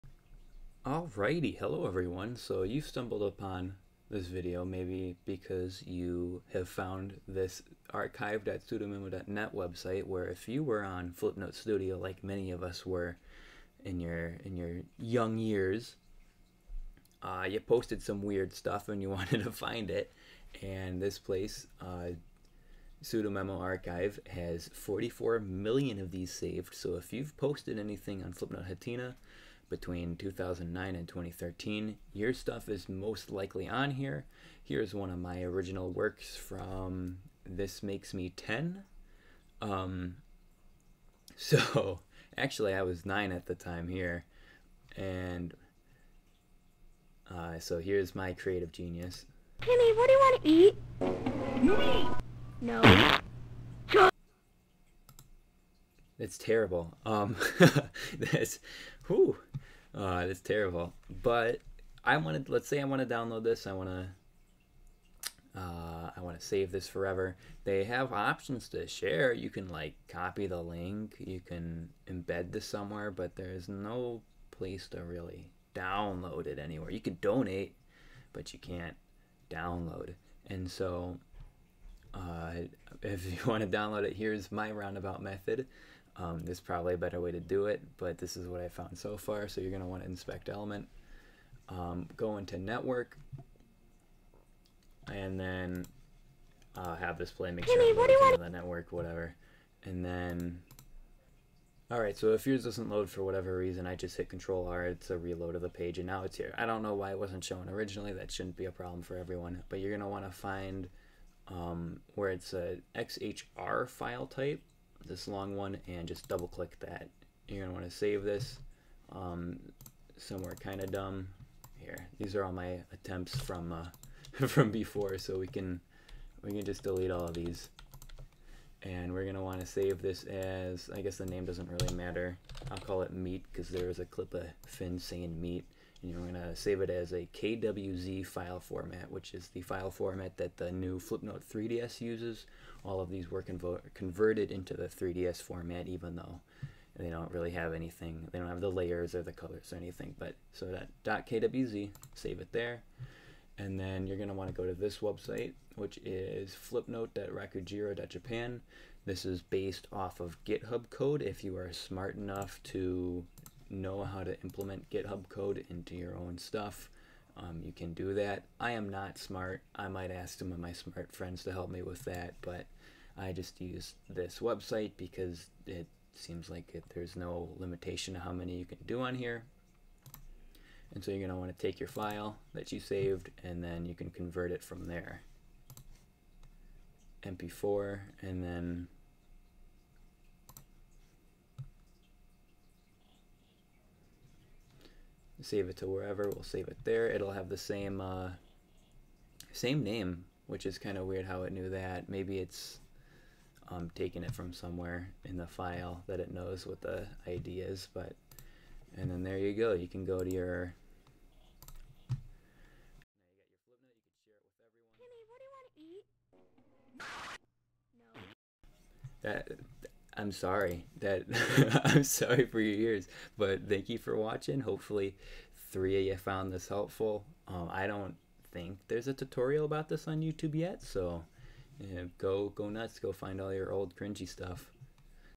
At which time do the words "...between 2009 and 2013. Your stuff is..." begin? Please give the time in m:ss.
0:29.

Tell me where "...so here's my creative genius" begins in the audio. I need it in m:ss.
0:47.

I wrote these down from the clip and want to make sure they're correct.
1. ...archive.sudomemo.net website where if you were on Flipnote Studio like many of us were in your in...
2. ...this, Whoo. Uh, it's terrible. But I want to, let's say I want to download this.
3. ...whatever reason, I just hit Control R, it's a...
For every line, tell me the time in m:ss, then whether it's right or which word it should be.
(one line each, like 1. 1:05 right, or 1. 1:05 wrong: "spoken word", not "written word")
1. 0:07 right
2. 0:58 right
3. 1:43 right.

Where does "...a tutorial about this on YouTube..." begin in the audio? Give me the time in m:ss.
3:49.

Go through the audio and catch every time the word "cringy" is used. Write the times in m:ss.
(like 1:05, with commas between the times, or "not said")
3:53.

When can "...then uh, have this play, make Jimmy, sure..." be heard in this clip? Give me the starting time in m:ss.
1:35.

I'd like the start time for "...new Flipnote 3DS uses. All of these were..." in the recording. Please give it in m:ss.
2:20.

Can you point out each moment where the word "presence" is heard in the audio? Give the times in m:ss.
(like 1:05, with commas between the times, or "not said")
not said.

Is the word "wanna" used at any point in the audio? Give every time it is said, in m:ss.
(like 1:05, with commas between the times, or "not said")
1:57, 2:09.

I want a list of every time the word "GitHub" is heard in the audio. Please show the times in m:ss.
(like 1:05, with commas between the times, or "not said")
2:40, 2:44.